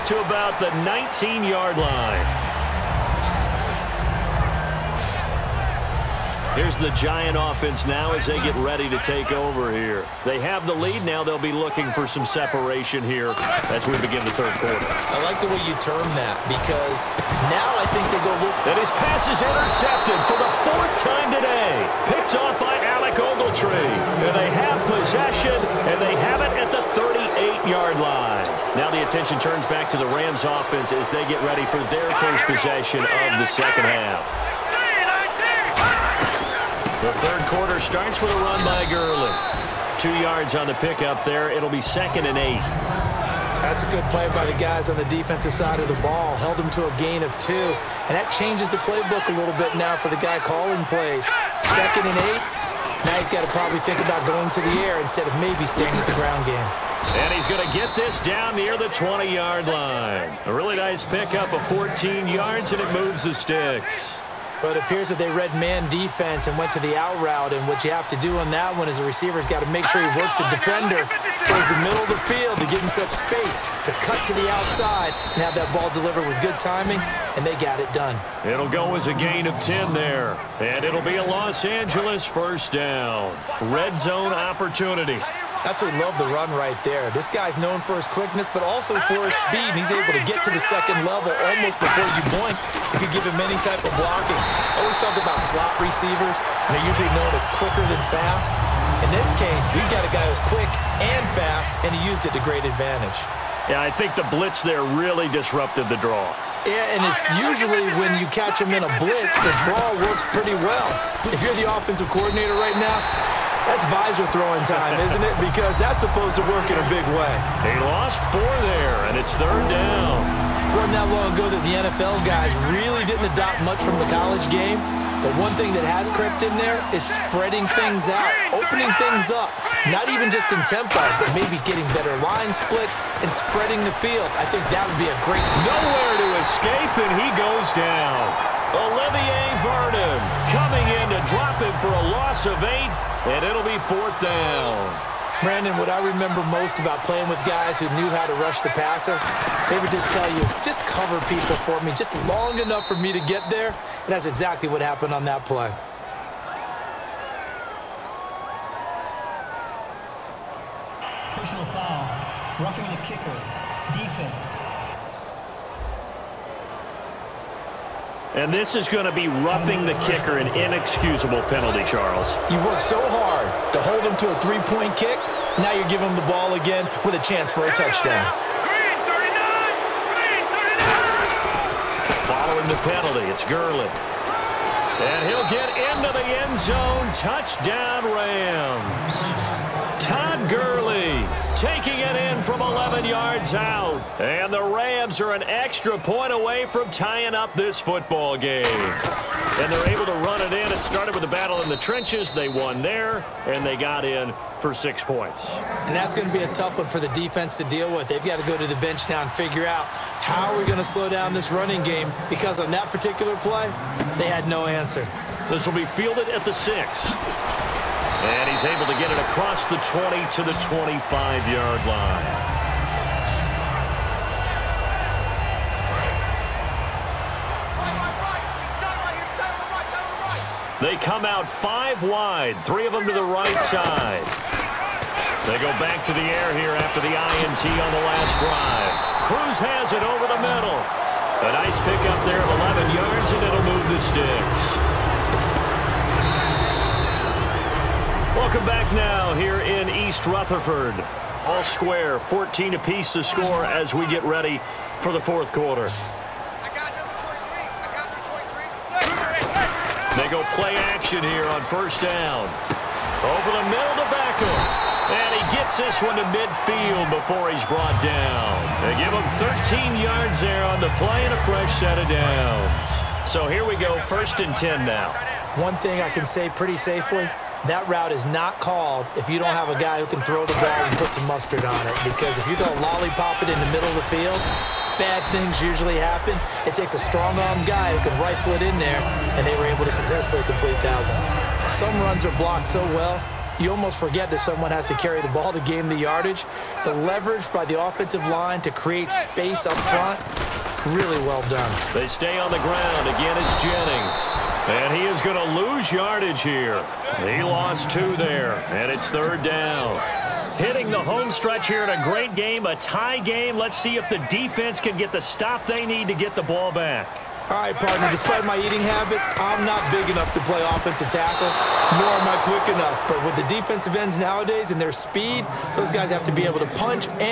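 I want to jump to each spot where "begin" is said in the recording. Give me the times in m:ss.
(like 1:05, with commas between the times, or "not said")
0:14.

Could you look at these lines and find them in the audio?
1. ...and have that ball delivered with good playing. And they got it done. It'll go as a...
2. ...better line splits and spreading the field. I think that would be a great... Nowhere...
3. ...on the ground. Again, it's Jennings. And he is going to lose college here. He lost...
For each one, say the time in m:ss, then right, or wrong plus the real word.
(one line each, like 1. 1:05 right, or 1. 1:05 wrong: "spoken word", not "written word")
1. 1:15 wrong: "timing", not "playing"
2. 2:11 right
3. 5:02 wrong: "yardage", not "college".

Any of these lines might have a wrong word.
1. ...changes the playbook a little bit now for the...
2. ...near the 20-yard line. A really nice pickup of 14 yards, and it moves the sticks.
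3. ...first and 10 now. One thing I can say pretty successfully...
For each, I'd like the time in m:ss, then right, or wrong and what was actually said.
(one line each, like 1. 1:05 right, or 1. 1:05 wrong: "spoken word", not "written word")
1. 0:48 right
2. 0:58 right
3. 4:34 wrong: "safely", not "successfully".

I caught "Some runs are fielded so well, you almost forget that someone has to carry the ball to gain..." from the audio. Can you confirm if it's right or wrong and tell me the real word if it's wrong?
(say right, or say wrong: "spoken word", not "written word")
wrong: "blocked", not "fielded".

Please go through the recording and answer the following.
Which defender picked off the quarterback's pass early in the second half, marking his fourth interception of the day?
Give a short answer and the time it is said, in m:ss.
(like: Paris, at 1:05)
Alec Ogletree, at 0:22.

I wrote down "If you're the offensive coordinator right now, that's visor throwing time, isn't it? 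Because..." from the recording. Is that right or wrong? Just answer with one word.
right.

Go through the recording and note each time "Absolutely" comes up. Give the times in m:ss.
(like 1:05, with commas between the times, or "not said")
1:25.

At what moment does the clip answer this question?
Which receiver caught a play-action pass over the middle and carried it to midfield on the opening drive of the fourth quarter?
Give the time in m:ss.
4:24.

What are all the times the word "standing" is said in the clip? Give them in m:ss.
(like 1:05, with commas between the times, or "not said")
not said.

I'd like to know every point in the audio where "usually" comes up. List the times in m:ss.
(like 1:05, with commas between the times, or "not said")
1:36, 1:47, 4:45.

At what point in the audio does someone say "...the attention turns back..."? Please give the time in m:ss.
0:28.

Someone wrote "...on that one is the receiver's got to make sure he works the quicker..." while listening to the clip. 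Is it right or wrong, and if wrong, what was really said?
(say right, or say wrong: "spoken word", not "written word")
wrong: "defender", not "quicker".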